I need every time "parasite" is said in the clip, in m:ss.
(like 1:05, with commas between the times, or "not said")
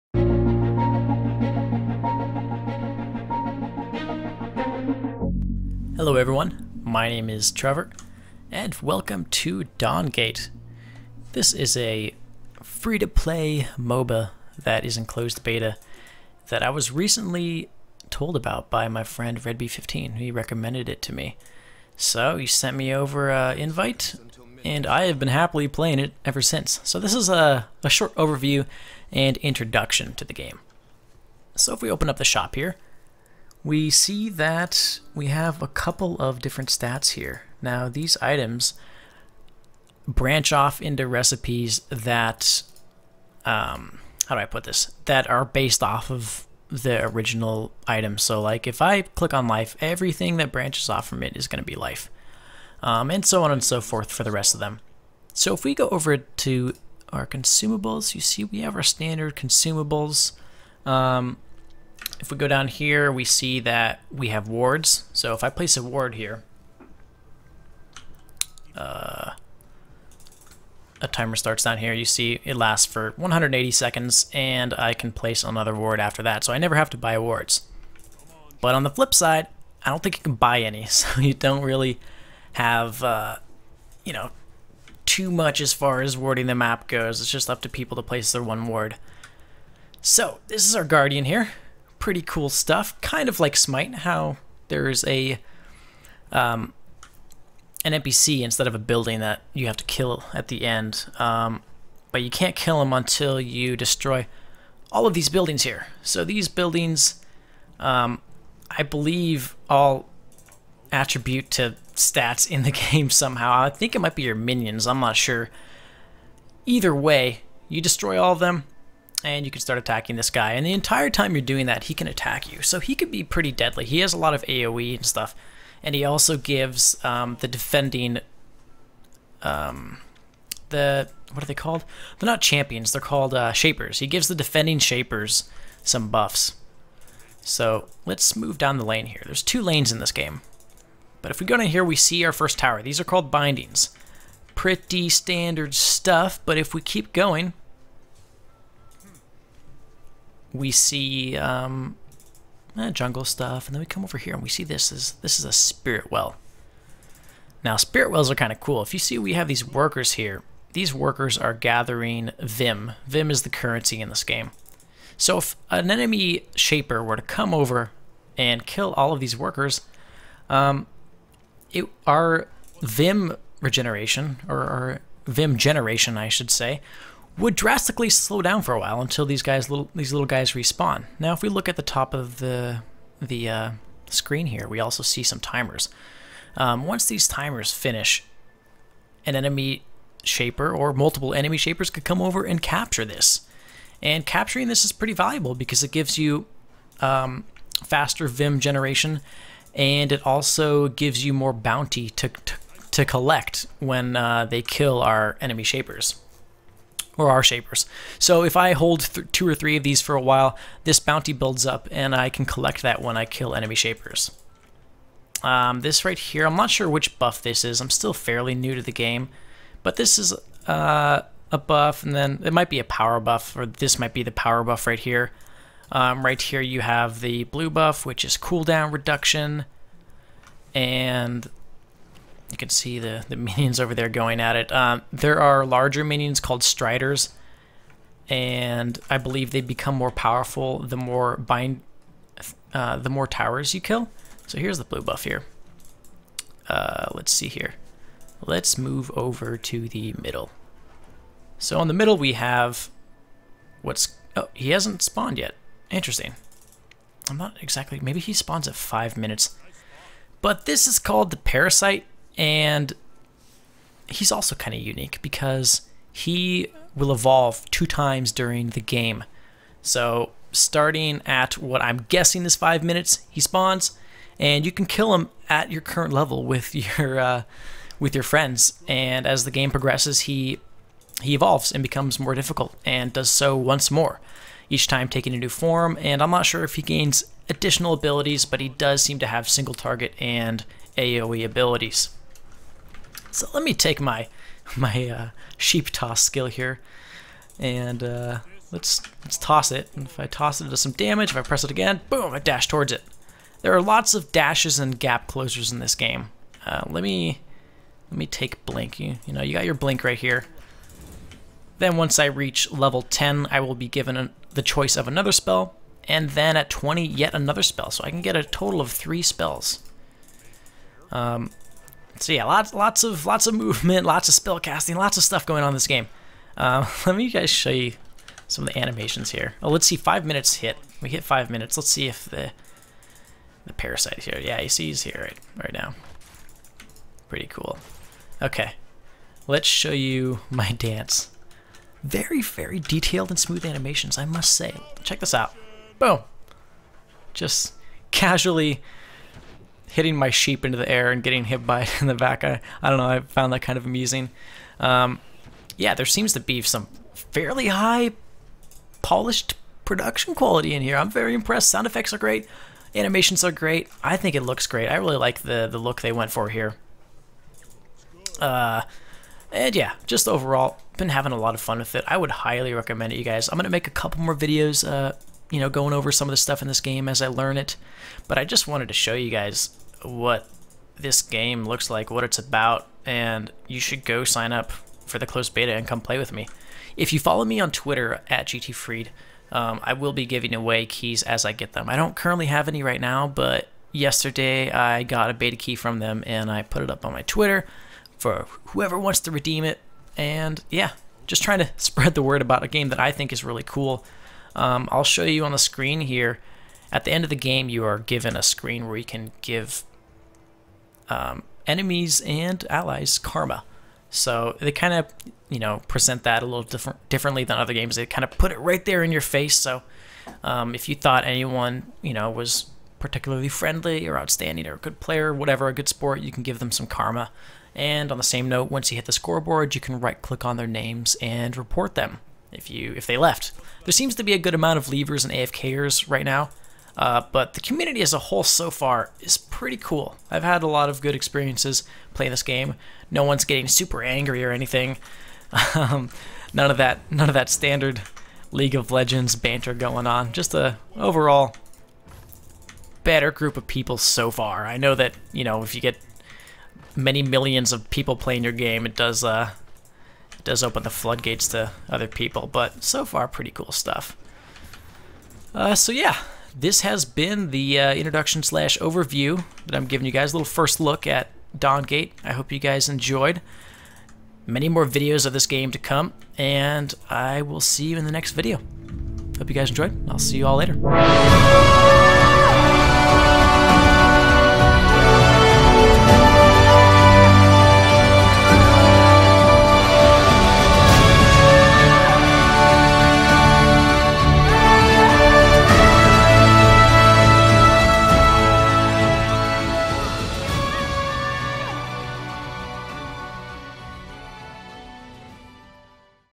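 4:21, 5:33.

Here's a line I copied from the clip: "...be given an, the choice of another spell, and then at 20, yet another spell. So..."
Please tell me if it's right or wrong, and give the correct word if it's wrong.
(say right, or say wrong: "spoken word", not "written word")
right.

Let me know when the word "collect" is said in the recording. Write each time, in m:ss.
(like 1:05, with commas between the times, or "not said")
3:23, 3:32.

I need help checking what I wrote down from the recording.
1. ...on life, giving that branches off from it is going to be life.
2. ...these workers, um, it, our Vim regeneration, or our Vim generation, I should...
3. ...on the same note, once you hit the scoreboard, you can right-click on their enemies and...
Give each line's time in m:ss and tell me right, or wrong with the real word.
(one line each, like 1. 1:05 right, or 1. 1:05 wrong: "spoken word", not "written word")
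1. 0:49 wrong: "everything", not "giving"
2. 2:49 right
3. 7:08 wrong: "names", not "enemies".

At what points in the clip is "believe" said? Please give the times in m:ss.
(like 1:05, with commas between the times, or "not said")
1:48, 3:59.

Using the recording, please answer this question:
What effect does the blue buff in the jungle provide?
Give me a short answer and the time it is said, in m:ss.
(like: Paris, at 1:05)
cooldown reduction, at 3:48.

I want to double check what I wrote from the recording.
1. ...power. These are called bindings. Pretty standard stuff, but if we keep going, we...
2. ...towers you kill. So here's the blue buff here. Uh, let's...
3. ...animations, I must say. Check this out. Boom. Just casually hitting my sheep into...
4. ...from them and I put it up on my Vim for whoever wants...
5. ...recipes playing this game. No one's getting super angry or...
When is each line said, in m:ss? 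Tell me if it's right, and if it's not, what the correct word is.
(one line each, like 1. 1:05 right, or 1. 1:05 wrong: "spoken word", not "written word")
1. 2:22 wrong: "tower", not "power"
2. 4:03 right
3. 5:43 right
4. 6:35 wrong: "Twitter", not "Vim"
5. 7:21 wrong: "experiences", not "recipes".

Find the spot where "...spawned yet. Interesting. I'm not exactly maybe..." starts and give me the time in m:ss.
4:15.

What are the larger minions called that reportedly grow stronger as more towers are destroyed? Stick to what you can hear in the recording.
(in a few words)
Striders.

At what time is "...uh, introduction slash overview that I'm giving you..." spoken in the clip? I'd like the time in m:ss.
7:47.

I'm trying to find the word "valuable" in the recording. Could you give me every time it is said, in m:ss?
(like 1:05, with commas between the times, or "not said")
3:15.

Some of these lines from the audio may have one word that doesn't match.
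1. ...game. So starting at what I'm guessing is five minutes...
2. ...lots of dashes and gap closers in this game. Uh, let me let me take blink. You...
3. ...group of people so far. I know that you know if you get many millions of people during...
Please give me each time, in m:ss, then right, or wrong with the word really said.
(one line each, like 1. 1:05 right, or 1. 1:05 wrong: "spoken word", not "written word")
1. 4:28 right
2. 5:03 right
3. 7:33 wrong: "playing", not "during".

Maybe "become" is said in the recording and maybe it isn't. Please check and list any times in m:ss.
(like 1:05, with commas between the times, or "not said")
3:59, 4:41.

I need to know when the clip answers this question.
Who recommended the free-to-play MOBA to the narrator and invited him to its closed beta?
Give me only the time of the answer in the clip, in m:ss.
0:19.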